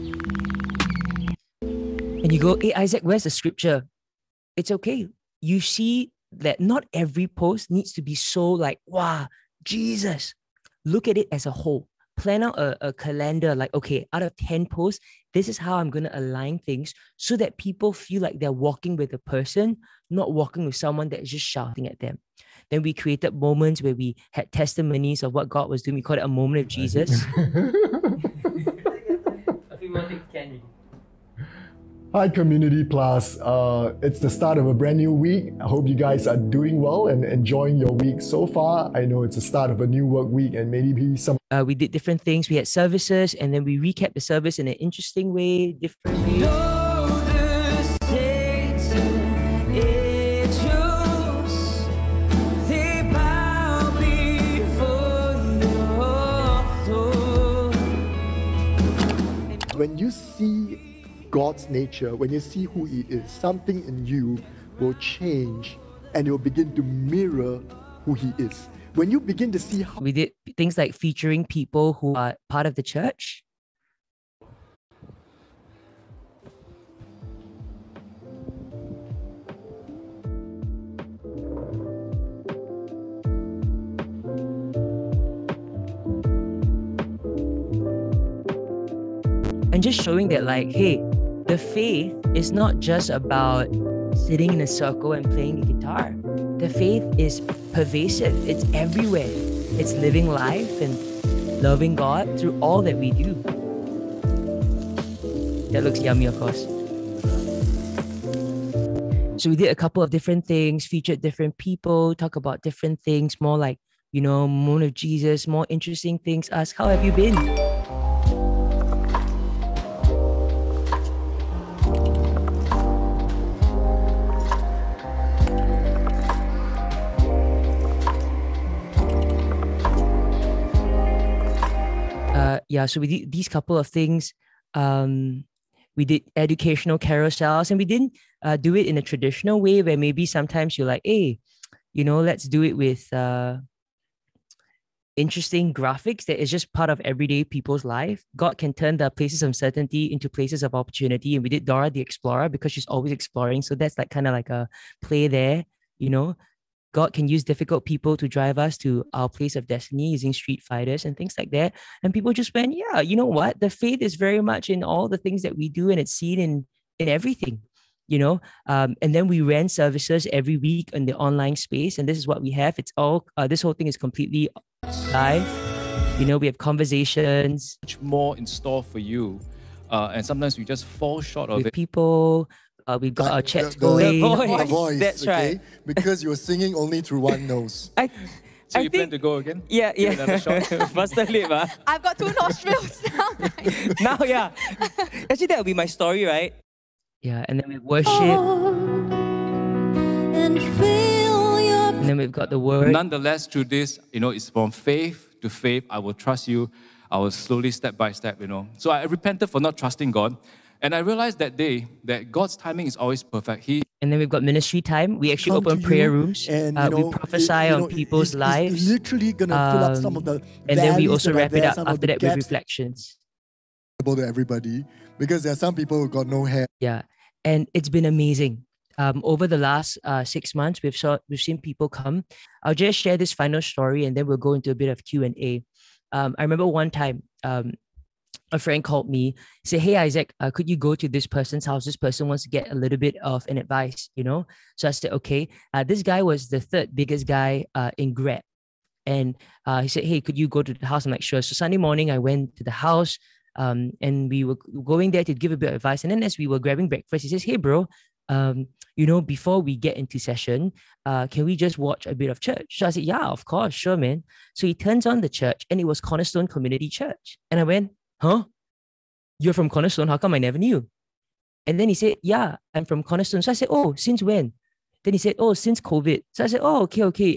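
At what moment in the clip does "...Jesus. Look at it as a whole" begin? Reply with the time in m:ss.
0:09.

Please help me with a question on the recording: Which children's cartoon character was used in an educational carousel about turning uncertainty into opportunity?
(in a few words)
Dora the Explorer.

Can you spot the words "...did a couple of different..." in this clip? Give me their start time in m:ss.
1:49.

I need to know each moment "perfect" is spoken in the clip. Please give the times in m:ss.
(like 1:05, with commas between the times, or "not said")
3:33.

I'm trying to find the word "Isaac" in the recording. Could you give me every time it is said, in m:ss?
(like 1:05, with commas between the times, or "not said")
0:02, 3:59.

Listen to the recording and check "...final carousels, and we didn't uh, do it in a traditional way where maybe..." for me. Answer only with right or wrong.
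wrong.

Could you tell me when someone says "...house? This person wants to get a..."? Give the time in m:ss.
4:01.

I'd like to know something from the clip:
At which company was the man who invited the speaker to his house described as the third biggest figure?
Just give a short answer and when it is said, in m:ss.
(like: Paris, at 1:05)
Grab, at 4:08.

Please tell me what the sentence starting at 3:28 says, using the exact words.
So I repented for not trusting God.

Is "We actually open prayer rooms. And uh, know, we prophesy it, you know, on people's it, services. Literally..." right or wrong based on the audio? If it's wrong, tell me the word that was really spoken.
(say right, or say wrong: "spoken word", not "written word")
wrong: "lives", not "services".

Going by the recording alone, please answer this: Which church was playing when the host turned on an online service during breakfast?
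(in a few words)
Cornerstone Community Church.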